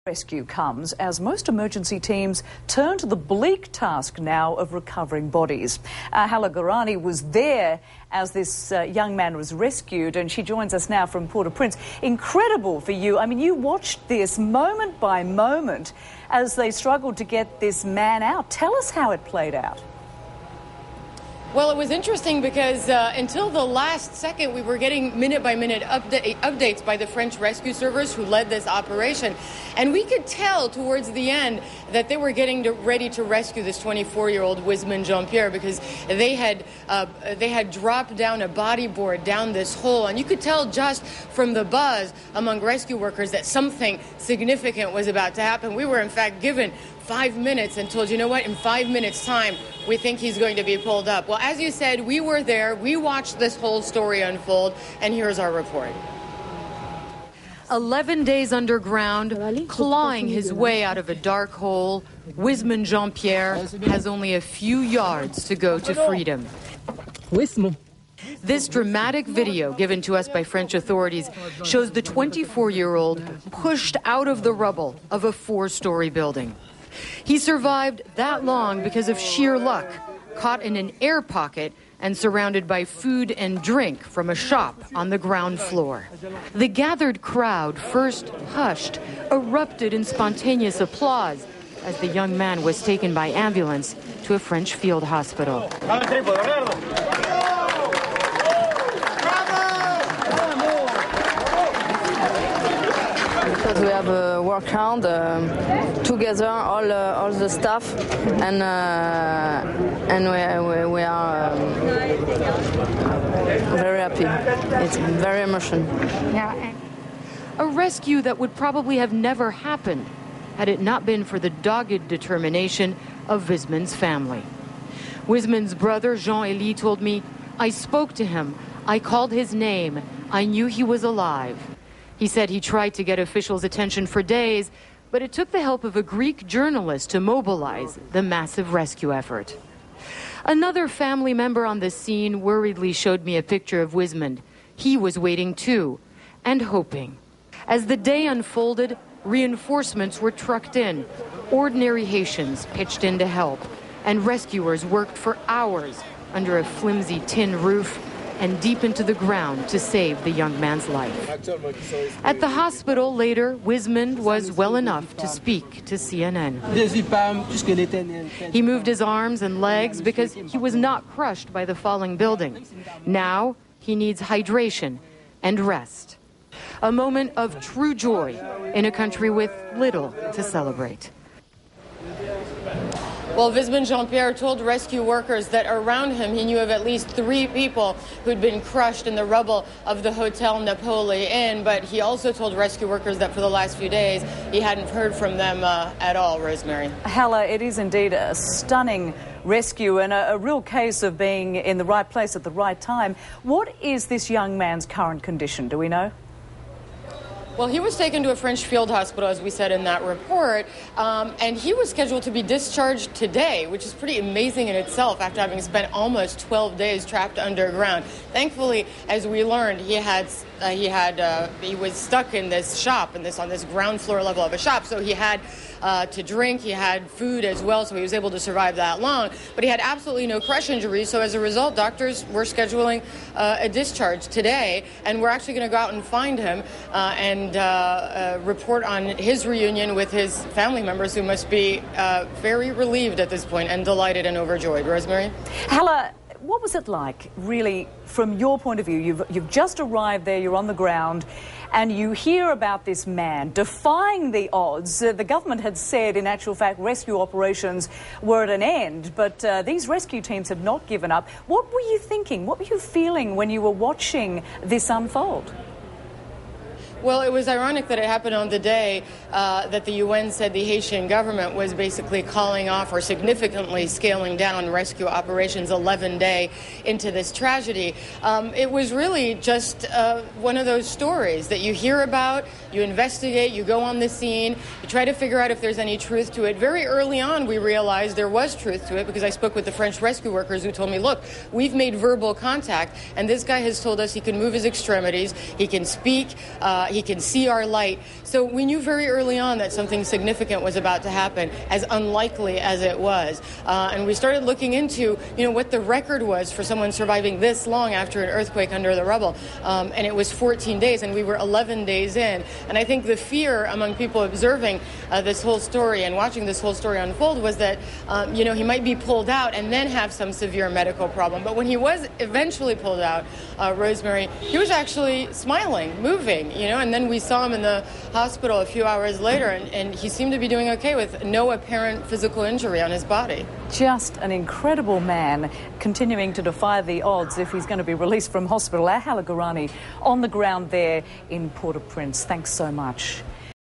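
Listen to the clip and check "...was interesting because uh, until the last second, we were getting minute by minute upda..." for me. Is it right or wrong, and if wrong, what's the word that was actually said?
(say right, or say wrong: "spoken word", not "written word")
right.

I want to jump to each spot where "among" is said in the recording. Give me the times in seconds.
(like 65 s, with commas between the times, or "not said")
42 s, 313 s.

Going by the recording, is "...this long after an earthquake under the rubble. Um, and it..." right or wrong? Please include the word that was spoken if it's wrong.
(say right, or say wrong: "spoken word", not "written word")
right.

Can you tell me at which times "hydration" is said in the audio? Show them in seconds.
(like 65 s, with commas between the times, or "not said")
174 s.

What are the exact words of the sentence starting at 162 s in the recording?
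At the hospital later, Wismond was well enough to speak to CNN.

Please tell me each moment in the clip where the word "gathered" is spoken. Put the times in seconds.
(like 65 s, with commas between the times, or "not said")
86 s.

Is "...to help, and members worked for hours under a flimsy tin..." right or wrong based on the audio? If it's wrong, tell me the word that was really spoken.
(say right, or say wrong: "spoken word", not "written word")
wrong: "rescuers", not "members".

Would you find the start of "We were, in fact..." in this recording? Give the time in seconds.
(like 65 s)
45 s.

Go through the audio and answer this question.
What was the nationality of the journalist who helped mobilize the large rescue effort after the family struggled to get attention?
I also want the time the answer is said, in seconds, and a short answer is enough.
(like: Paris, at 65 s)
Greek, at 136 s.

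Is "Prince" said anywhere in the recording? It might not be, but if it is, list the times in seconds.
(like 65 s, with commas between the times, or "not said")
11 s, 341 s.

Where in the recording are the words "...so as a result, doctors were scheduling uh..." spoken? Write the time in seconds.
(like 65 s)
231 s.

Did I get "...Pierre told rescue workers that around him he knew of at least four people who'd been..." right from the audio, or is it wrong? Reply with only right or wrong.
wrong.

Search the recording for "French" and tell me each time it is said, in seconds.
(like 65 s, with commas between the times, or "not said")
27 s, 70 s, 94 s, 208 s, 289 s.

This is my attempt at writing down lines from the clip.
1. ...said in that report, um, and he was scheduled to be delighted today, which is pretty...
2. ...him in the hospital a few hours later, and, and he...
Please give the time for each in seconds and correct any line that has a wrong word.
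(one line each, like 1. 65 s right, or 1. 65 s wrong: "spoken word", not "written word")
1. 209 s wrong: "discharged", not "delighted"
2. 327 s right.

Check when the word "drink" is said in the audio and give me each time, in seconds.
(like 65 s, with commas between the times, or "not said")
83 s, 226 s.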